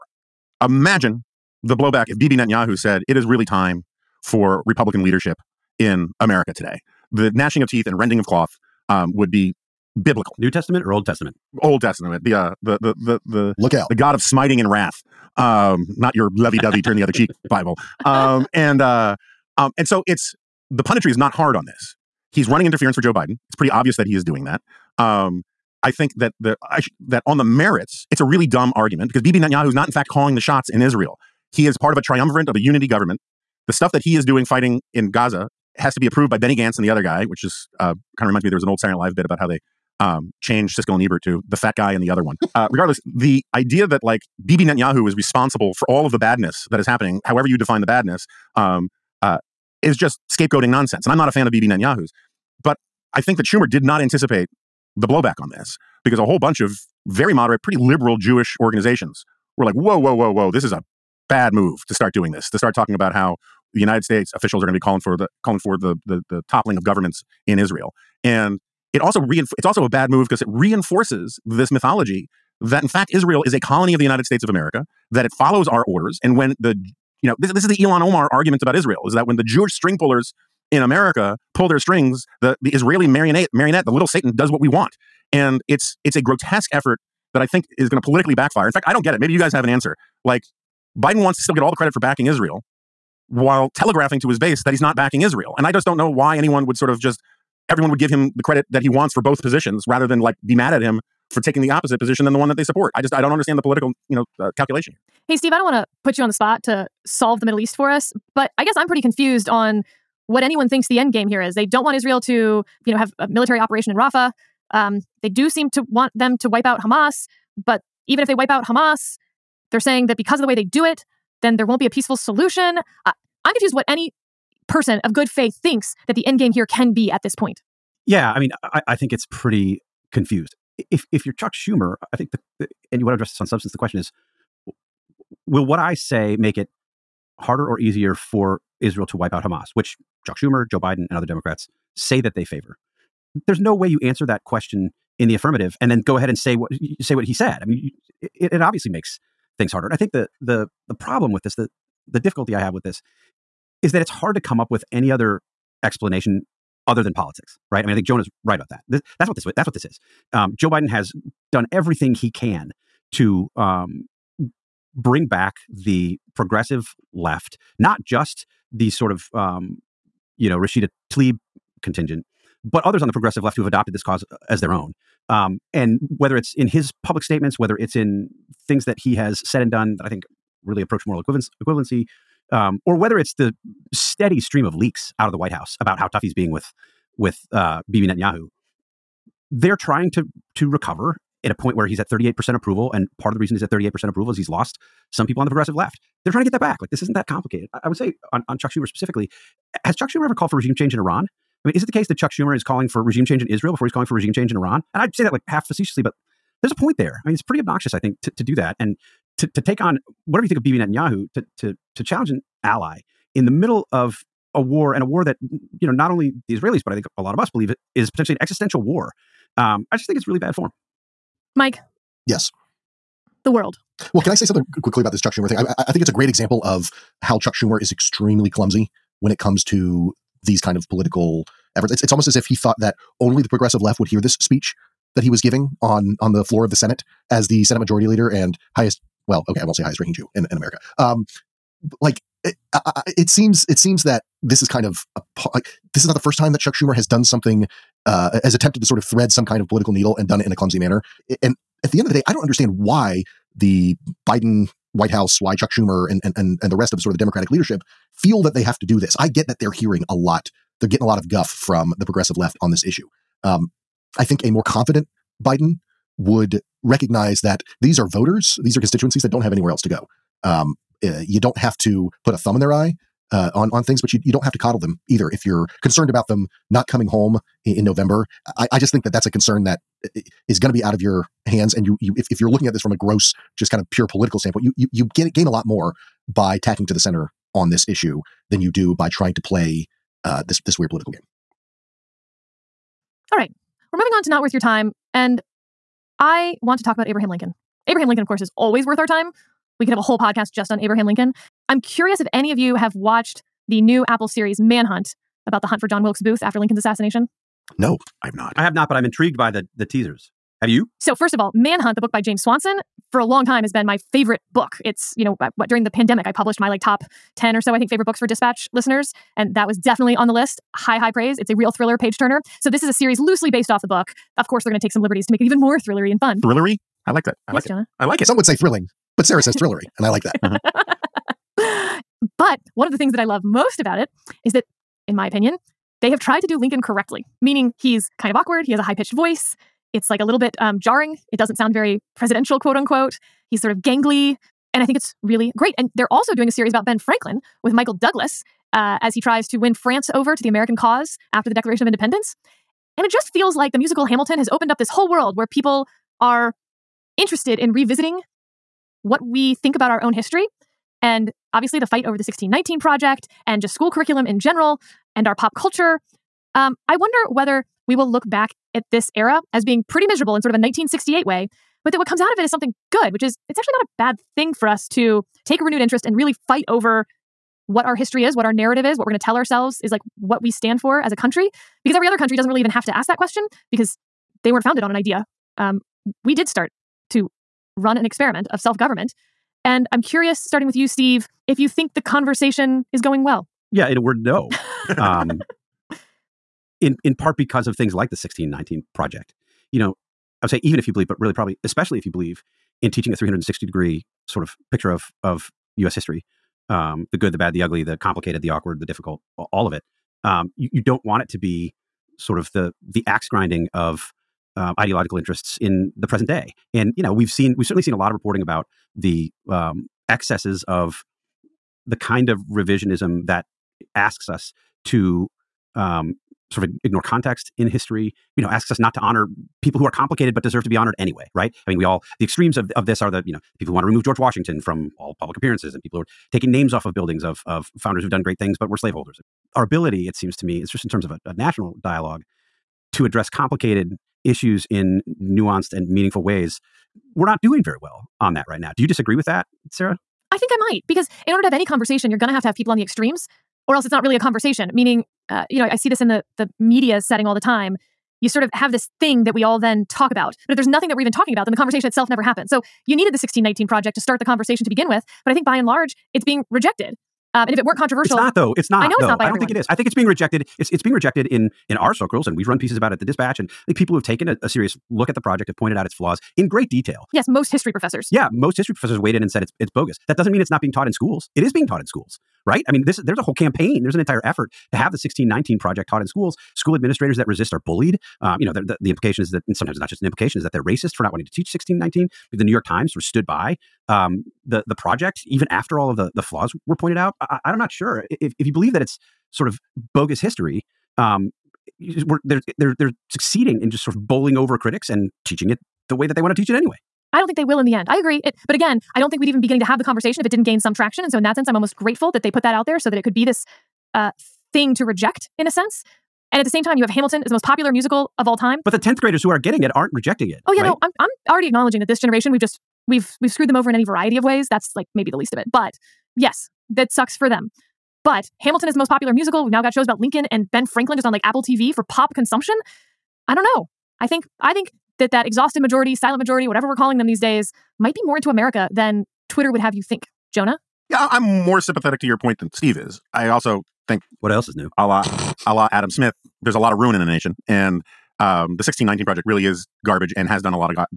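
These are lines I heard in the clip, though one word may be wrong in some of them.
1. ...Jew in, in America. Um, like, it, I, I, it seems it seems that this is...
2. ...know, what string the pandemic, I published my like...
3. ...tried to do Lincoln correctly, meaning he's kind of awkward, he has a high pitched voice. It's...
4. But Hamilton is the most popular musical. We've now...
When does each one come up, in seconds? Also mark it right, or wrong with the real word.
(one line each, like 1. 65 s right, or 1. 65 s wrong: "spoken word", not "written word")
1. 240 s right
2. 315 s wrong: "during", not "string"
3. 336 s right
4. 528 s right.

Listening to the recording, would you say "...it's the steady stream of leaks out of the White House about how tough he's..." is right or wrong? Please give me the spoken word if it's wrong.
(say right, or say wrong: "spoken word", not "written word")
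right.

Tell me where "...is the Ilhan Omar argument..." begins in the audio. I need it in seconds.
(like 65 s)
77 s.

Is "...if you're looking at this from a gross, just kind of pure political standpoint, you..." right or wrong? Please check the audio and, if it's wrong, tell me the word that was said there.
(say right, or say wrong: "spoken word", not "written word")
right.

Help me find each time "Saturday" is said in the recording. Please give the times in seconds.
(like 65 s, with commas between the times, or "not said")
38 s.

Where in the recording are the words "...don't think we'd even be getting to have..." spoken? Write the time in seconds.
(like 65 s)
508 s.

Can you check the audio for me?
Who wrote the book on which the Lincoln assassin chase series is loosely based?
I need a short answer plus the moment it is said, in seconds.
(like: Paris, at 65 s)
James Swanson, at 312 s.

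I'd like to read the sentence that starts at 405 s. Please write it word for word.
history: um, the good, the bad, the ugly, the complicated, the awkward, the difficult, all of it.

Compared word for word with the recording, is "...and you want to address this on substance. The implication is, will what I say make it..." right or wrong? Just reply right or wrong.
wrong.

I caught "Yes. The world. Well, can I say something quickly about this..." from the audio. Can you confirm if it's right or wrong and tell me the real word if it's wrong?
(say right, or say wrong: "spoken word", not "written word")
right.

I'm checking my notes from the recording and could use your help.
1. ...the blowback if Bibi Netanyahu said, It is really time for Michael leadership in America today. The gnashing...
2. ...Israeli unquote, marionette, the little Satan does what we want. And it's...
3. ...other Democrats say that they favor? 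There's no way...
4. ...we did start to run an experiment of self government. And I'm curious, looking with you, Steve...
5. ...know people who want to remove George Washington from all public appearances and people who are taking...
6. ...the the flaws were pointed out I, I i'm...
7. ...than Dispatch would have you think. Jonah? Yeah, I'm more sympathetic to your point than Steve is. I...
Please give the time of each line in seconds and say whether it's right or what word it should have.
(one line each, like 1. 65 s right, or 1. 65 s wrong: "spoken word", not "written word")
1. 1 s wrong: "Republican", not "Michael"
2. 82 s wrong: "marionette", not "unquote"
3. 141 s right
4. 386 s wrong: "starting", not "looking"
5. 433 s right
6. 495 s right
7. 538 s wrong: "Twitter", not "Dispatch".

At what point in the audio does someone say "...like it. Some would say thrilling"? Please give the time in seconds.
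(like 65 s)
328 s.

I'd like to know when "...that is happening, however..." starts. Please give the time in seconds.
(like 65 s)
46 s.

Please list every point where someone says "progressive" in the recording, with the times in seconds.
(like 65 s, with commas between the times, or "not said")
166 s, 173 s, 195 s, 233 s, 262 s.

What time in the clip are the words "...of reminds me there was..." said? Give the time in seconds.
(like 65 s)
38 s.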